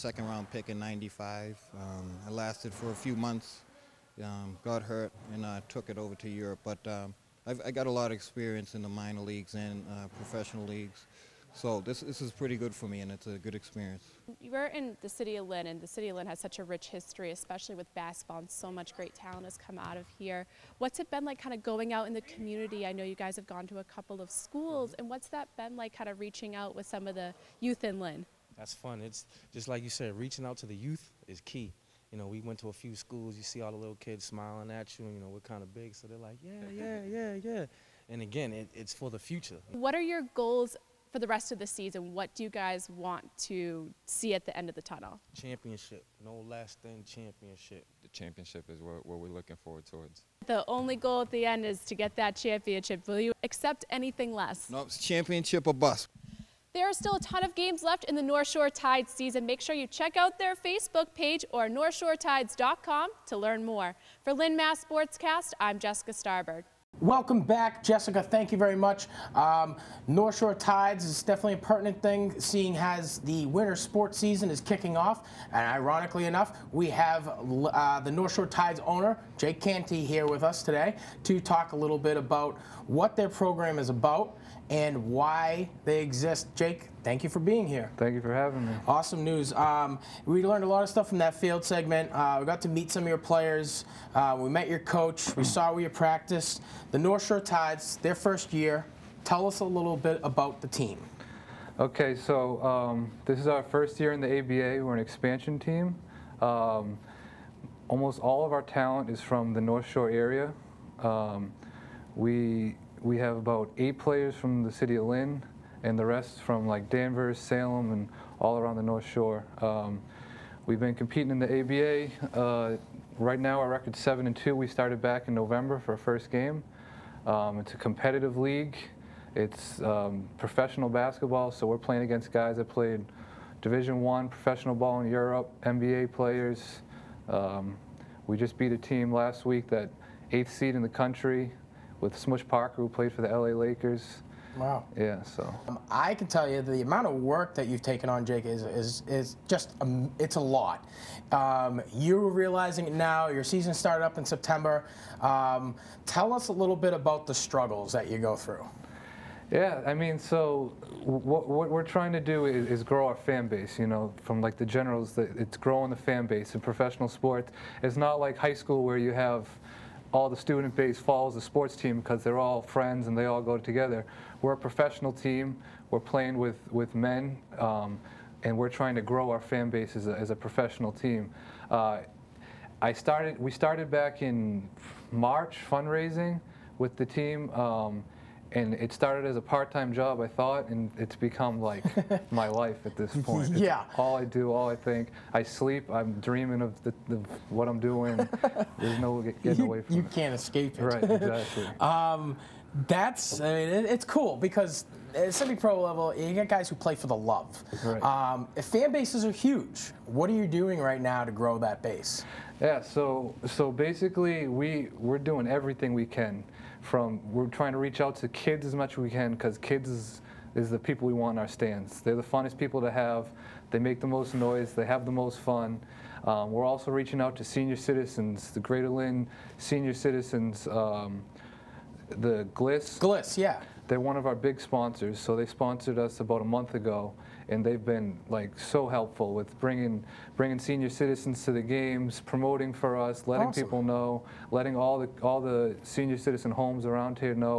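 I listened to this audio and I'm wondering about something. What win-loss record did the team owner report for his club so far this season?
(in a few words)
7-2.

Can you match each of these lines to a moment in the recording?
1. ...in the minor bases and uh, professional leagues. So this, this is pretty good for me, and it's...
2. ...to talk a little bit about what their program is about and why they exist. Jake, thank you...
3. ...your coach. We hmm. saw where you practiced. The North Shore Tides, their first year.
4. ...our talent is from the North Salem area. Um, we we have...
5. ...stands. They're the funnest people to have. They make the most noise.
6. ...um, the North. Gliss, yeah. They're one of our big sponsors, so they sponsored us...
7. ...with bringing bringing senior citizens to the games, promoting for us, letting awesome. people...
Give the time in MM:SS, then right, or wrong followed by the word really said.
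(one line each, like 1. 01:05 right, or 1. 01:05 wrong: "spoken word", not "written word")
1. 00:08 wrong: "leagues", not "bases"
2. 01:21 right
3. 01:34 right
4. 01:48 wrong: "Shore", not "Salem"
5. 03:41 right
6. 03:50 wrong: "Gliss", not "North"
7. 03:59 right.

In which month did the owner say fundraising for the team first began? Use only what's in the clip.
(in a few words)
March.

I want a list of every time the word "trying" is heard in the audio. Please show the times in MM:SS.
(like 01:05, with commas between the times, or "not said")
02:41, 02:58, 03:37.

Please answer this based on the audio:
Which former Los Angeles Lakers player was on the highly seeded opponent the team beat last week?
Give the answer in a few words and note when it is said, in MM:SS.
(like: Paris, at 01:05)
Smush Parker, at 02:22.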